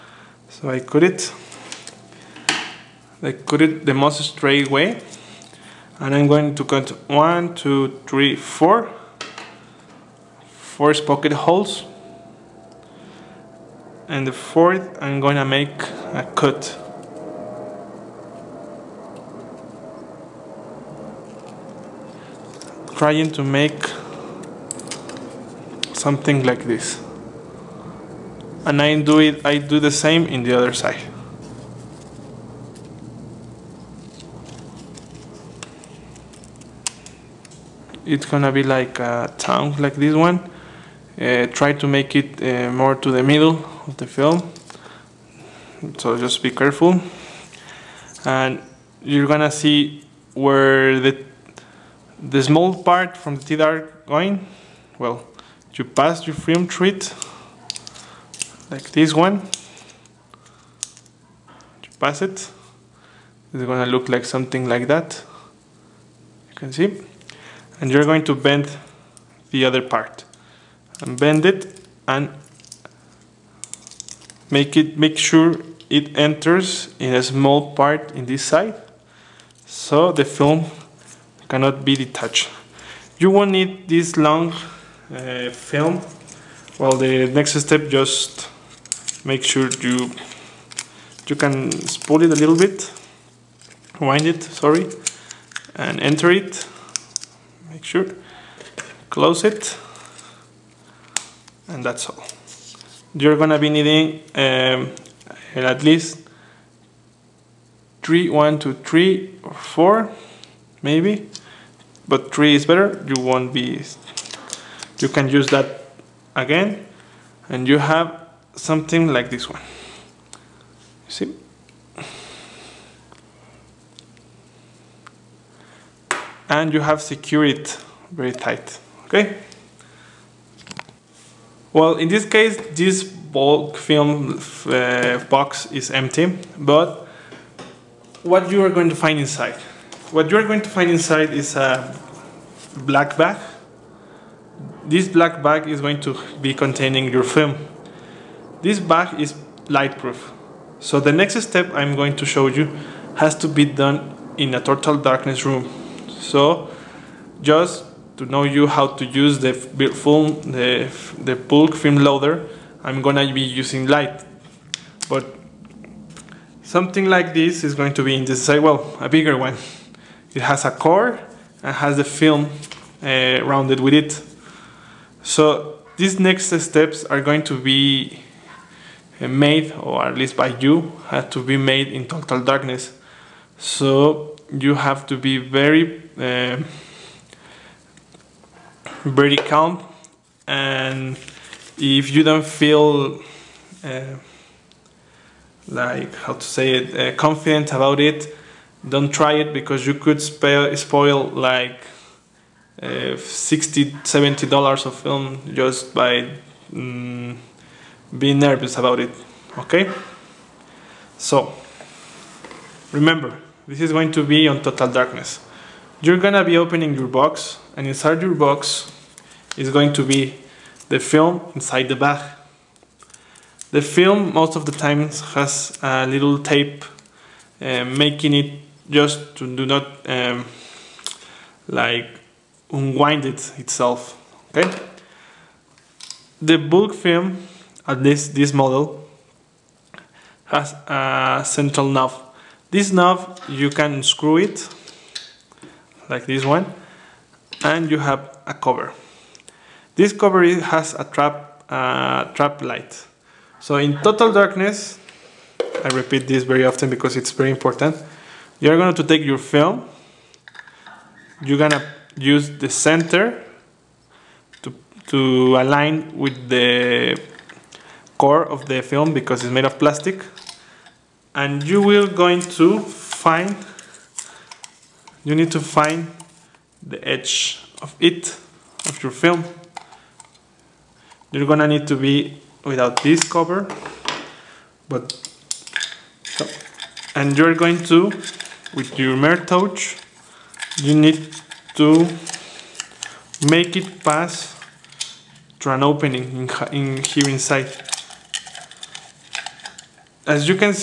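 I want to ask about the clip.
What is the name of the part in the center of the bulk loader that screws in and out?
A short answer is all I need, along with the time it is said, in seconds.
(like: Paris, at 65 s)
Central knob, at 241 s.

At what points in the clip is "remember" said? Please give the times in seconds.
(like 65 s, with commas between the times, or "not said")
212 s.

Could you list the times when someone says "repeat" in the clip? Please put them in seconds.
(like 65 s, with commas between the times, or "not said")
255 s.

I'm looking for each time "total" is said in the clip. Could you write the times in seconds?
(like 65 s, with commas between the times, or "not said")
154 s, 182 s, 214 s, 254 s.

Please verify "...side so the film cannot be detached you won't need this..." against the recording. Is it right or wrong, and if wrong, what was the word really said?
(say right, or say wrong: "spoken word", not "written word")
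right.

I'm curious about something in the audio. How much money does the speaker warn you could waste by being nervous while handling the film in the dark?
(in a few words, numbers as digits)
$60-70.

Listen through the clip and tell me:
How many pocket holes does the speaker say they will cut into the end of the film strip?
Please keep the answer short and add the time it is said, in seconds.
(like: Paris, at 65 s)
4, at 10 s.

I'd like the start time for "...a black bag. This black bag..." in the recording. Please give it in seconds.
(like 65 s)
141 s.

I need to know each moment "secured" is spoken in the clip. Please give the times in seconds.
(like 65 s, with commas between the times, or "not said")
127 s.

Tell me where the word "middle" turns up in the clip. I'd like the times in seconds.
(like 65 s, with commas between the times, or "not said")
43 s.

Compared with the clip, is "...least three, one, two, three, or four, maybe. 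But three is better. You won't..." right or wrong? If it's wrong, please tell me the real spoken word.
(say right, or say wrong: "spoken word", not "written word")
right.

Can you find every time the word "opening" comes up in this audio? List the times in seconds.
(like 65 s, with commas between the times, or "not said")
216 s, 295 s.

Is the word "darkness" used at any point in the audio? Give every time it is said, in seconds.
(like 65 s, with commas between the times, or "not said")
154 s, 182 s, 214 s, 254 s.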